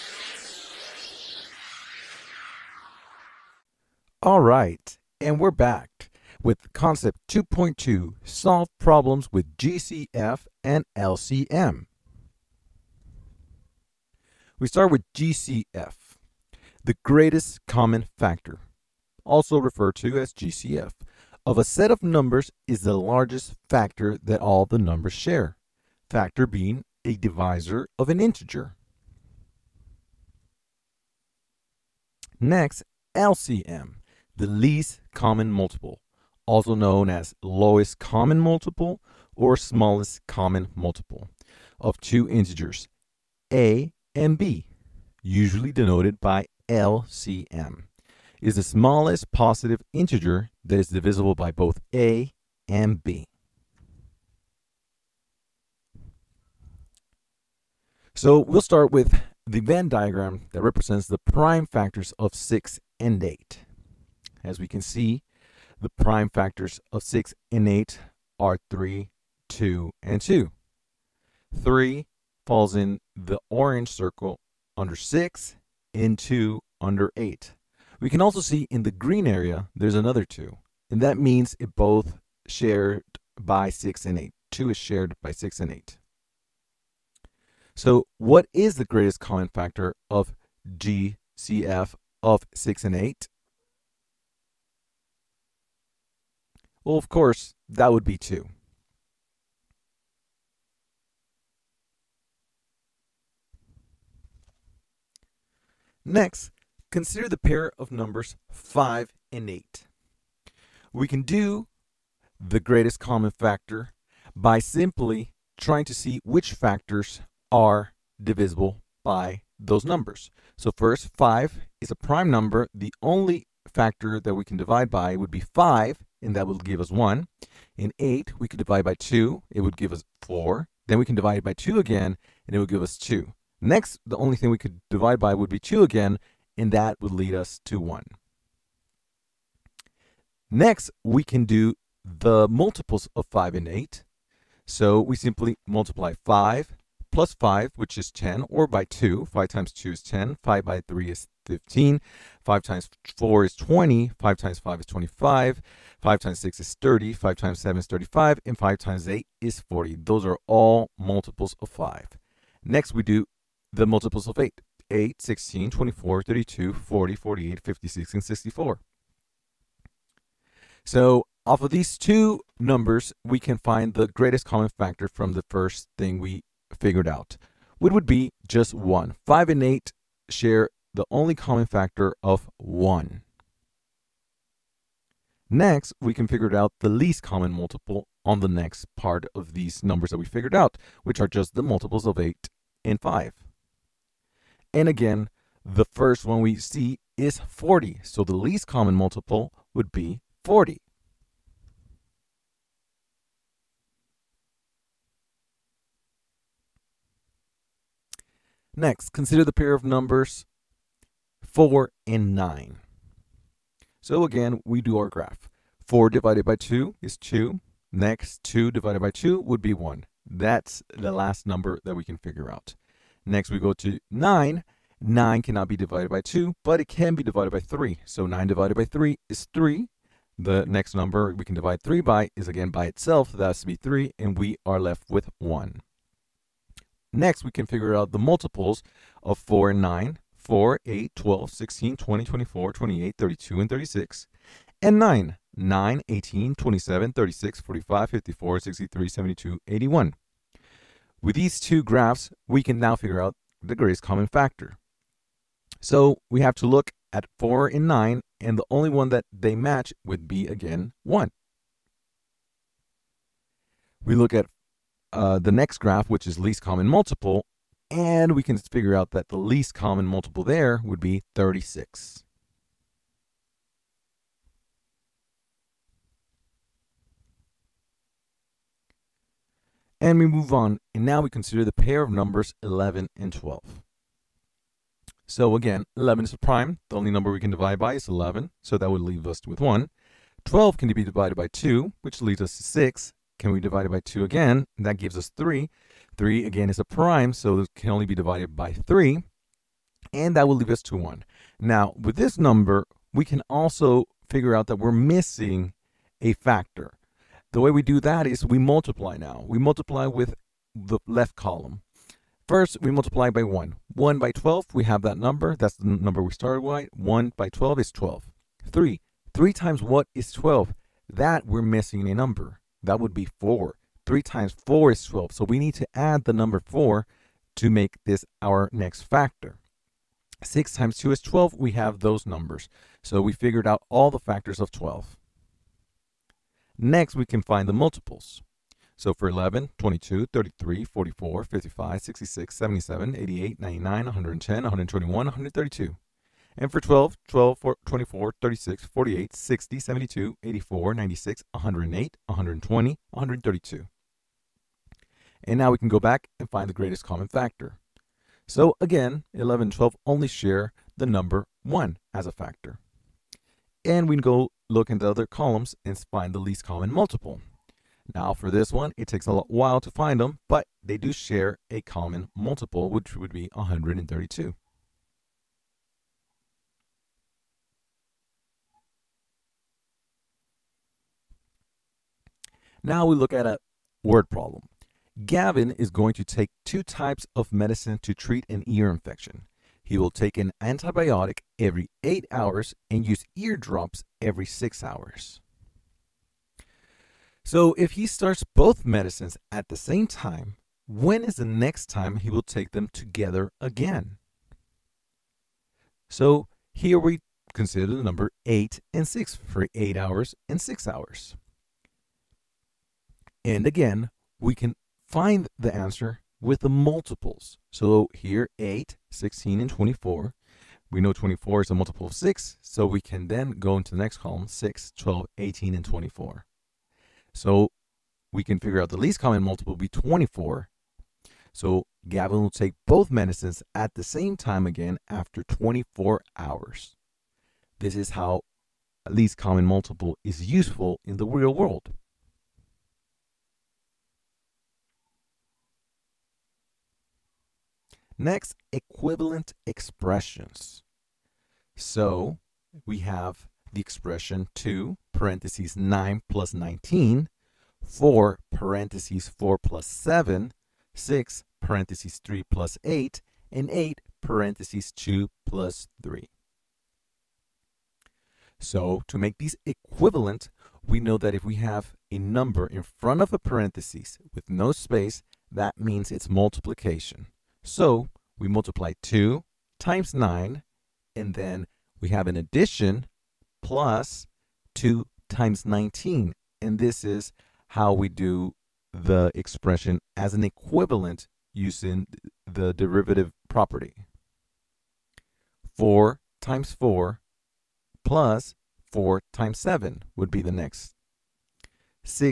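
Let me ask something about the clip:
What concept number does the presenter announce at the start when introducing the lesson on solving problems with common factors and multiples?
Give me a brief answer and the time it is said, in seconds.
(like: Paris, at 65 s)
2.2, at 6 s.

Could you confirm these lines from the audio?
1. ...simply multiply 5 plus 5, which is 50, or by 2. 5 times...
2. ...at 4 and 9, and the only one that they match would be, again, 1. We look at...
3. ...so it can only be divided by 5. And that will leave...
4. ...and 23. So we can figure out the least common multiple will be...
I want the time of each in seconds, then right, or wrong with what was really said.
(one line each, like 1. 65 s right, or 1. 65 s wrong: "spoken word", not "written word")
1. 145 s wrong: "10", not "50"
2. 257 s right
3. 297 s wrong: "3", not "5"
4. 425 s wrong: "24", not "23".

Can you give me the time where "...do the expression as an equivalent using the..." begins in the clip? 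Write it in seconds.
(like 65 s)
488 s.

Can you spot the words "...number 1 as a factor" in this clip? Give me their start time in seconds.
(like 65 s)
361 s.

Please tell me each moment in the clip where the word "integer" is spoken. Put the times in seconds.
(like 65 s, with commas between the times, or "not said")
28 s, 42 s, 49 s.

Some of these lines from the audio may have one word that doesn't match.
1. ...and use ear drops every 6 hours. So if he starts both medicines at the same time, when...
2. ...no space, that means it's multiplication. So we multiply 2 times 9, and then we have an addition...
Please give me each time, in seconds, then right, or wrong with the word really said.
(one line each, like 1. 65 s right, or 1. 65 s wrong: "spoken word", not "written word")
1. 392 s right
2. 474 s right.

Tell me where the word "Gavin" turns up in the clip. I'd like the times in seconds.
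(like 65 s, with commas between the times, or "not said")
385 s, 432 s.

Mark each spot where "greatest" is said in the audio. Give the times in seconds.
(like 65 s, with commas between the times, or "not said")
17 s, 88 s, 112 s, 174 s, 253 s, 356 s.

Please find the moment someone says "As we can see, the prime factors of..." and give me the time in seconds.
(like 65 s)
64 s.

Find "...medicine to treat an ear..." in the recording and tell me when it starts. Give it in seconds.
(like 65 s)
387 s.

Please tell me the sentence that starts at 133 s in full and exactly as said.
Next, the only thing we could divide by would be 2 again, and that would lead us to 1.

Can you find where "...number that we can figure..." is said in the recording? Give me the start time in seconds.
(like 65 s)
221 s.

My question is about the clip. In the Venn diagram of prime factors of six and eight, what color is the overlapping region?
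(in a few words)
green.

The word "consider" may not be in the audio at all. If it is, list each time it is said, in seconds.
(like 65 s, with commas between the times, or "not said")
106 s, 209 s, 281 s, 407 s.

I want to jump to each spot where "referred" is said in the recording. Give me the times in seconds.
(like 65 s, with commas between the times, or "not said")
19 s.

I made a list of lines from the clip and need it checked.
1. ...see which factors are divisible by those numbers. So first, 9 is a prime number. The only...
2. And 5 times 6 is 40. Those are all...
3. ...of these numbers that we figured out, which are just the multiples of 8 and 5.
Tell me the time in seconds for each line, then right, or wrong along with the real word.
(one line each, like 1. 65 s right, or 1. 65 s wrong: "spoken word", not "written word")
1. 115 s wrong: "5", not "9"
2. 158 s wrong: "8", not "6"
3. 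189 s right.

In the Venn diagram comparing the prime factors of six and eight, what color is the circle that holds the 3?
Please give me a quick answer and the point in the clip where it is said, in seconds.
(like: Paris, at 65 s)
orange, at 73 s.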